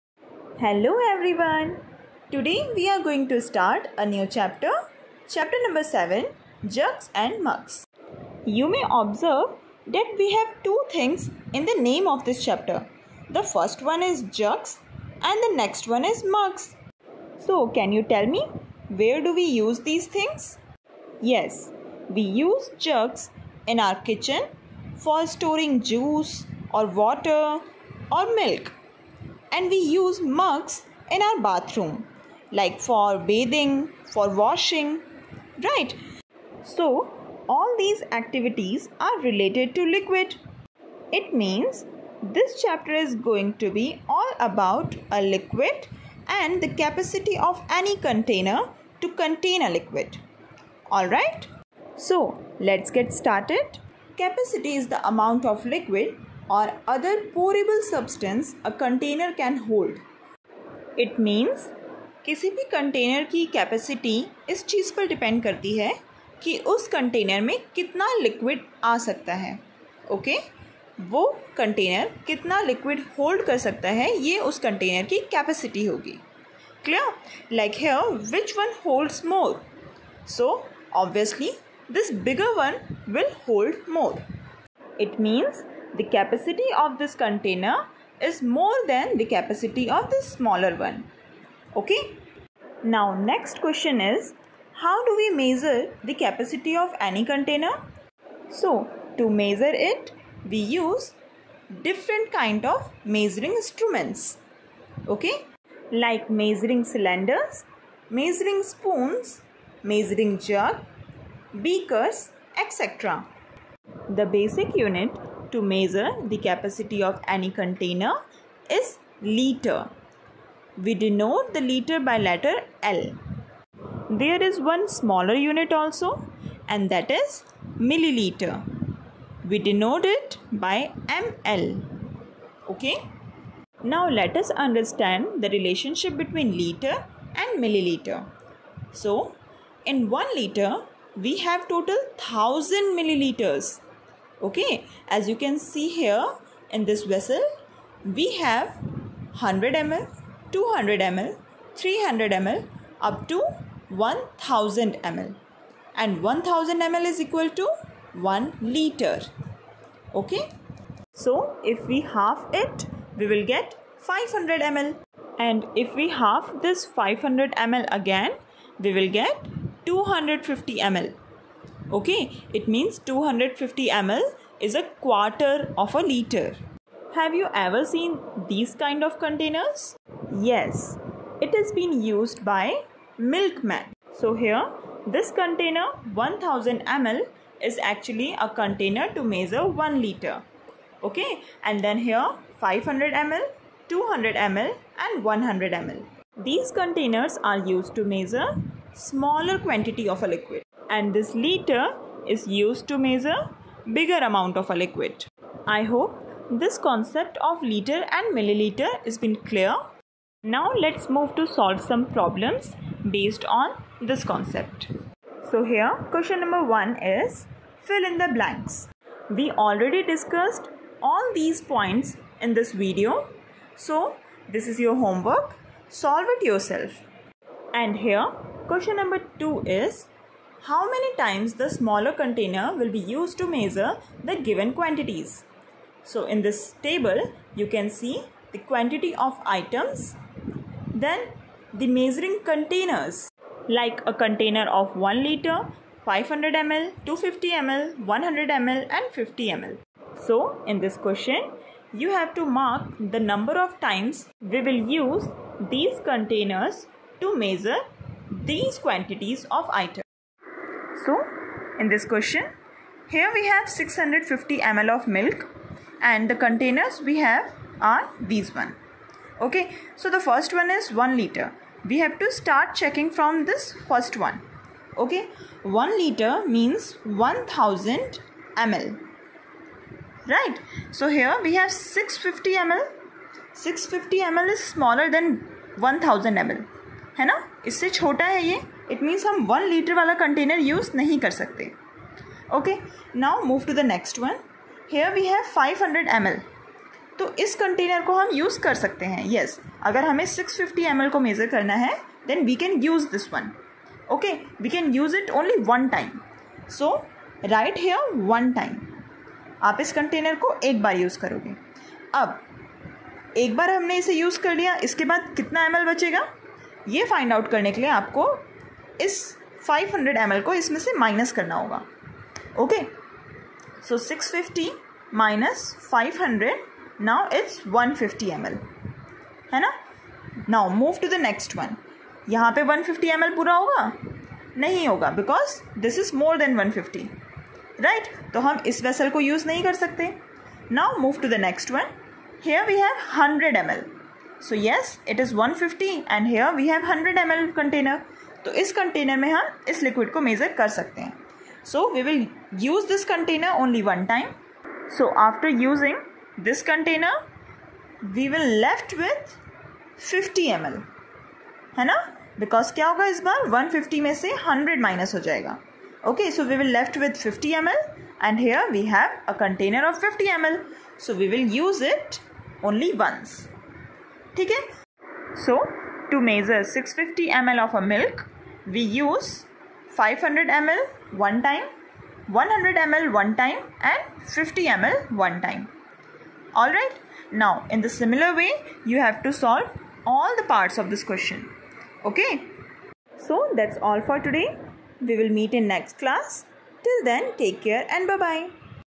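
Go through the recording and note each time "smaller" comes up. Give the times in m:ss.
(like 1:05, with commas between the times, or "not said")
1:30, 2:04, 3:18, 3:51, 4:44.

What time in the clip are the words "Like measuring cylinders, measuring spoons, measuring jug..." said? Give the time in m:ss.
1:45.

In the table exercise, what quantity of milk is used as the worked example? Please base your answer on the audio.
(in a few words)
650 ml.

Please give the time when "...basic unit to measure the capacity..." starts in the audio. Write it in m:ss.
1:54.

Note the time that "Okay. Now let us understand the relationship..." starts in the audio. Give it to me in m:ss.
2:12.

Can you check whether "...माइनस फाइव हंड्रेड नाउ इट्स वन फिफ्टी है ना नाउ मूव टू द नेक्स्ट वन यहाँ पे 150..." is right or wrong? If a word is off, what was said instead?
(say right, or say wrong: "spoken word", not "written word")
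right.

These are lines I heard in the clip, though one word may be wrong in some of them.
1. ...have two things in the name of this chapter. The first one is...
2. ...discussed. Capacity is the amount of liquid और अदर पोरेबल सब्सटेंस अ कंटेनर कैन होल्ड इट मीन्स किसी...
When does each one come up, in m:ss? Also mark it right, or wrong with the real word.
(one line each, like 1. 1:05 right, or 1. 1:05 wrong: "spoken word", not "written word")
1. 0:10 right
2. 0:53 wrong: "started", not "discussed".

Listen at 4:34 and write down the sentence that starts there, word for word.
Okay, 1 liter means 1000 ml.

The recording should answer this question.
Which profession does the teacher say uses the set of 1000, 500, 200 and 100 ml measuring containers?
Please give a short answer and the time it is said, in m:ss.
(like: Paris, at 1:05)
milkman, at 3:03.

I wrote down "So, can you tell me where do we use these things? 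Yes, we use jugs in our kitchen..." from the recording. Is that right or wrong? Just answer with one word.
right.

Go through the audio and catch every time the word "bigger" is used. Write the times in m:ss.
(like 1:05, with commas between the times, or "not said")
1:22, 3:23.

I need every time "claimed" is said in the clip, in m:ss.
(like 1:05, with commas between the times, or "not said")
not said.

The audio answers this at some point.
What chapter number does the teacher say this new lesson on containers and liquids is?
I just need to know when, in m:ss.
0:05.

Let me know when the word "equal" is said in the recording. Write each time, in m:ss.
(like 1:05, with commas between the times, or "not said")
2:37.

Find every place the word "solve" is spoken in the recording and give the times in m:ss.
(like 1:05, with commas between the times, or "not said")
3:31, 3:45, 6:29.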